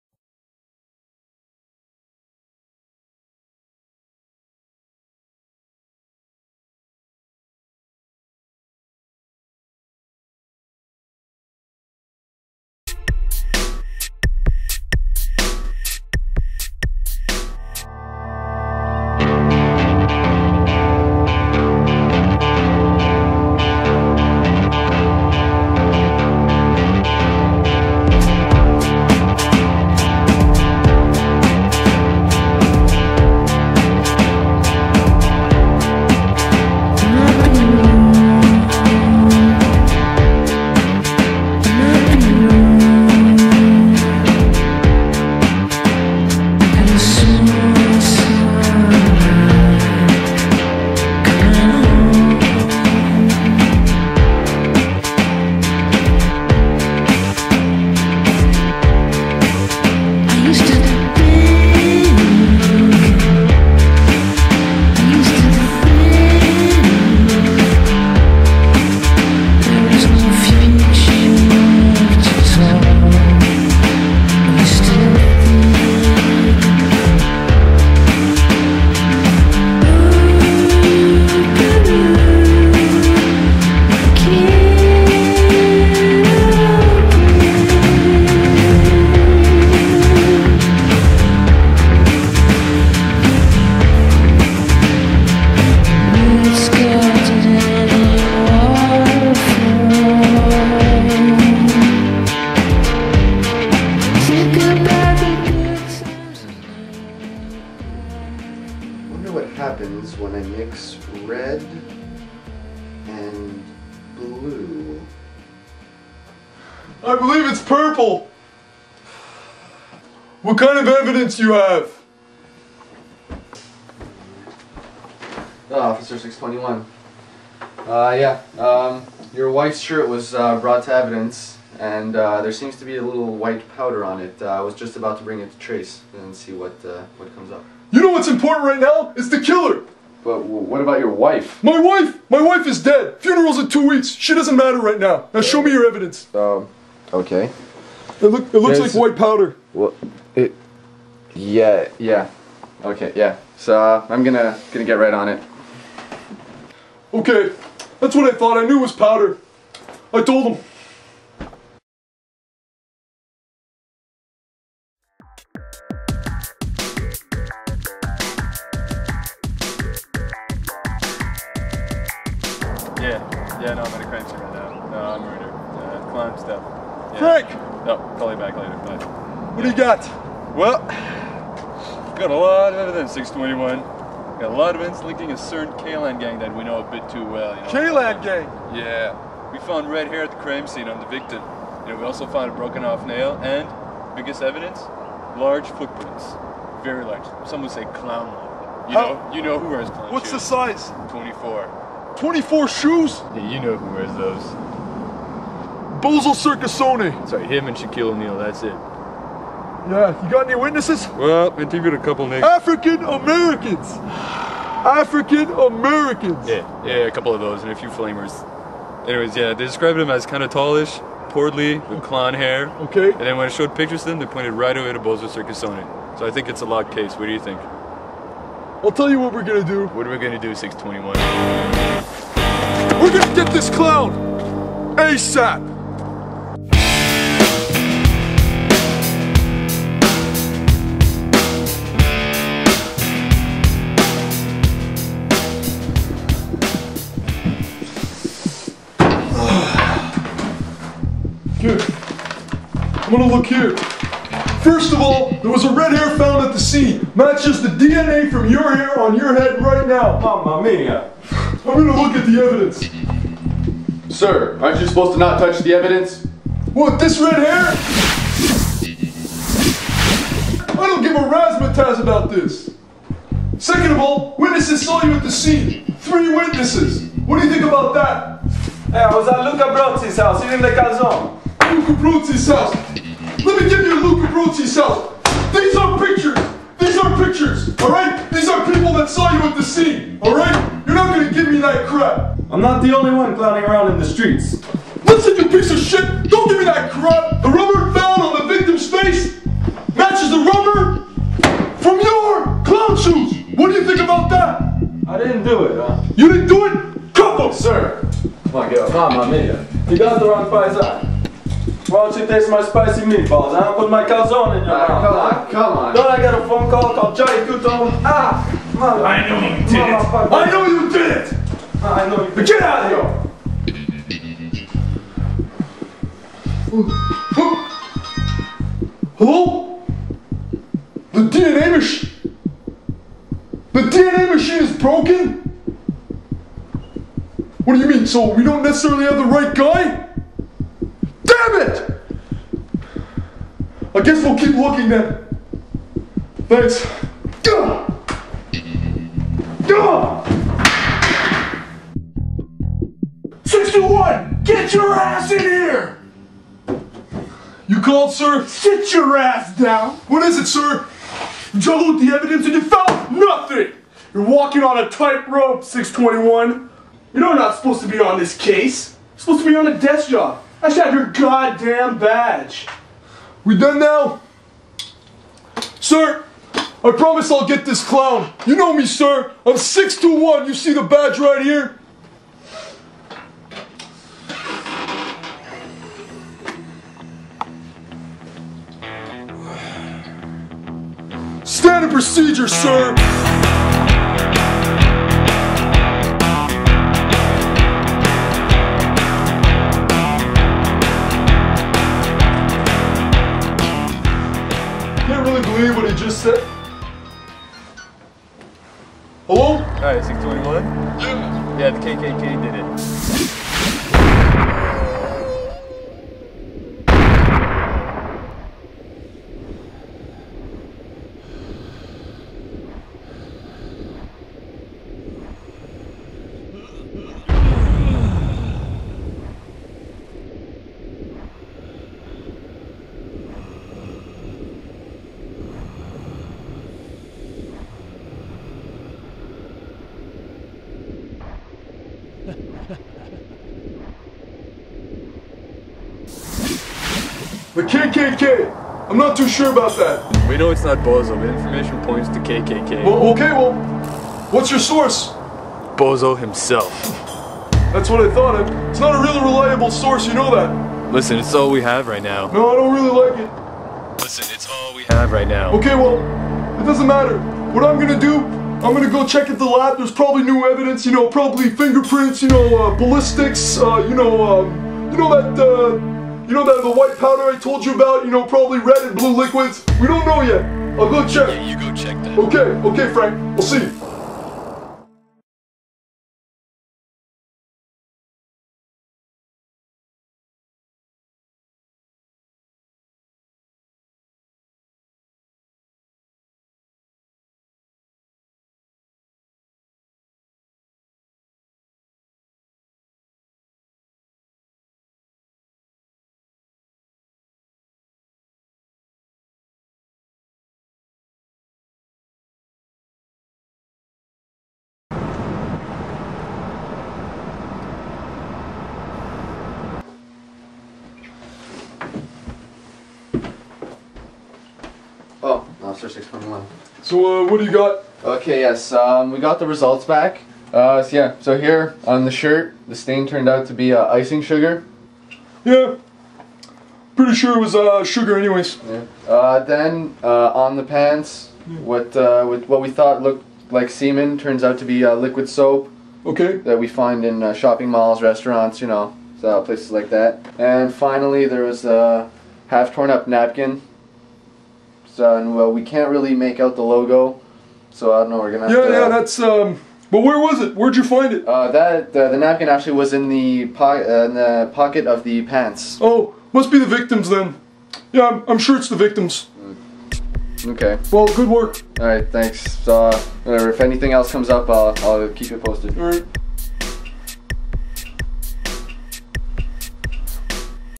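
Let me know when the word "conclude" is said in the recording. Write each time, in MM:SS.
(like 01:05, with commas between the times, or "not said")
not said.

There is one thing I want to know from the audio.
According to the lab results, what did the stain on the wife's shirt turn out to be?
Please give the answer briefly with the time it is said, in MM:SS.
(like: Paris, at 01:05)
icing sugar, at 08:53.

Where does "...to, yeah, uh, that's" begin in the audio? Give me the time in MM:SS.
09:18.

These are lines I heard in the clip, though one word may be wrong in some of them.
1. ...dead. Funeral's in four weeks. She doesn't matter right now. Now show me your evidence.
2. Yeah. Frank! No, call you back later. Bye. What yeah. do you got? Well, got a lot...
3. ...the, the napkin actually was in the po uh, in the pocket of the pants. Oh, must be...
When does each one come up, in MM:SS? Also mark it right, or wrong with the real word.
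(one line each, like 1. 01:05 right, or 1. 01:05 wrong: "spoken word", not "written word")
1. 02:22 wrong: "two", not "four"
2. 02:57 right
3. 09:21 right.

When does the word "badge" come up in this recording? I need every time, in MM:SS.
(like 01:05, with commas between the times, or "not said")
06:11, 06:20.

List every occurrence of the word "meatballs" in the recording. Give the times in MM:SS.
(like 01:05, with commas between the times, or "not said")
05:13.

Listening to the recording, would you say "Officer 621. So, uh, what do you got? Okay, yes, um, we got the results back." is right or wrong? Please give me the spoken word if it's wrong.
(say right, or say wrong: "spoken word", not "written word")
right.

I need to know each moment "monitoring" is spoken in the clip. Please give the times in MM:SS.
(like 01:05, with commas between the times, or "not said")
not said.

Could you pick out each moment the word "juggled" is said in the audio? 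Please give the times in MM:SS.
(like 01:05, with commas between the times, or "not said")
06:01.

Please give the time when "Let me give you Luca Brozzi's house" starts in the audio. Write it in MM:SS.
04:43.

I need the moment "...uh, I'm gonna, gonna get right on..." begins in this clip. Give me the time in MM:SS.
02:33.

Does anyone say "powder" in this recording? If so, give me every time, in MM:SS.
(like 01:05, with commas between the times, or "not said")
02:13, 02:29, 02:38, 07:56.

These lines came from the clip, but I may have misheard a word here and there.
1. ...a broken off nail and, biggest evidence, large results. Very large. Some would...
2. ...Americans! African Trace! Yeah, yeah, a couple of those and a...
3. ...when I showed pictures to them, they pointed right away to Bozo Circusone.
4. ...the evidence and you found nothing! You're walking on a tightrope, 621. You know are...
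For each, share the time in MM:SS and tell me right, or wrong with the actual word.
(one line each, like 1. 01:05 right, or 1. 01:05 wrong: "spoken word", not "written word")
1. 03:12 wrong: "footprints", not "results"
2. 03:33 wrong: "Americans", not "Trace"
3. 03:43 right
4. 06:02 right.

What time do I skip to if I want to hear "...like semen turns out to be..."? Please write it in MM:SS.
09:03.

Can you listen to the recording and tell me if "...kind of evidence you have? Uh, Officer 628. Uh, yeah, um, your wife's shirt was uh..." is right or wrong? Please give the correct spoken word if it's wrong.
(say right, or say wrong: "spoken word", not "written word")
wrong: "621", not "628".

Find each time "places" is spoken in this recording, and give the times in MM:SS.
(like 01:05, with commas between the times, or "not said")
09:09.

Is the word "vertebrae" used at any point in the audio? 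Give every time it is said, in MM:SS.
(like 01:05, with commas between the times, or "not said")
not said.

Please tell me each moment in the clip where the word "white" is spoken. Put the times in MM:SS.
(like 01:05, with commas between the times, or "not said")
02:13, 02:28, 07:56.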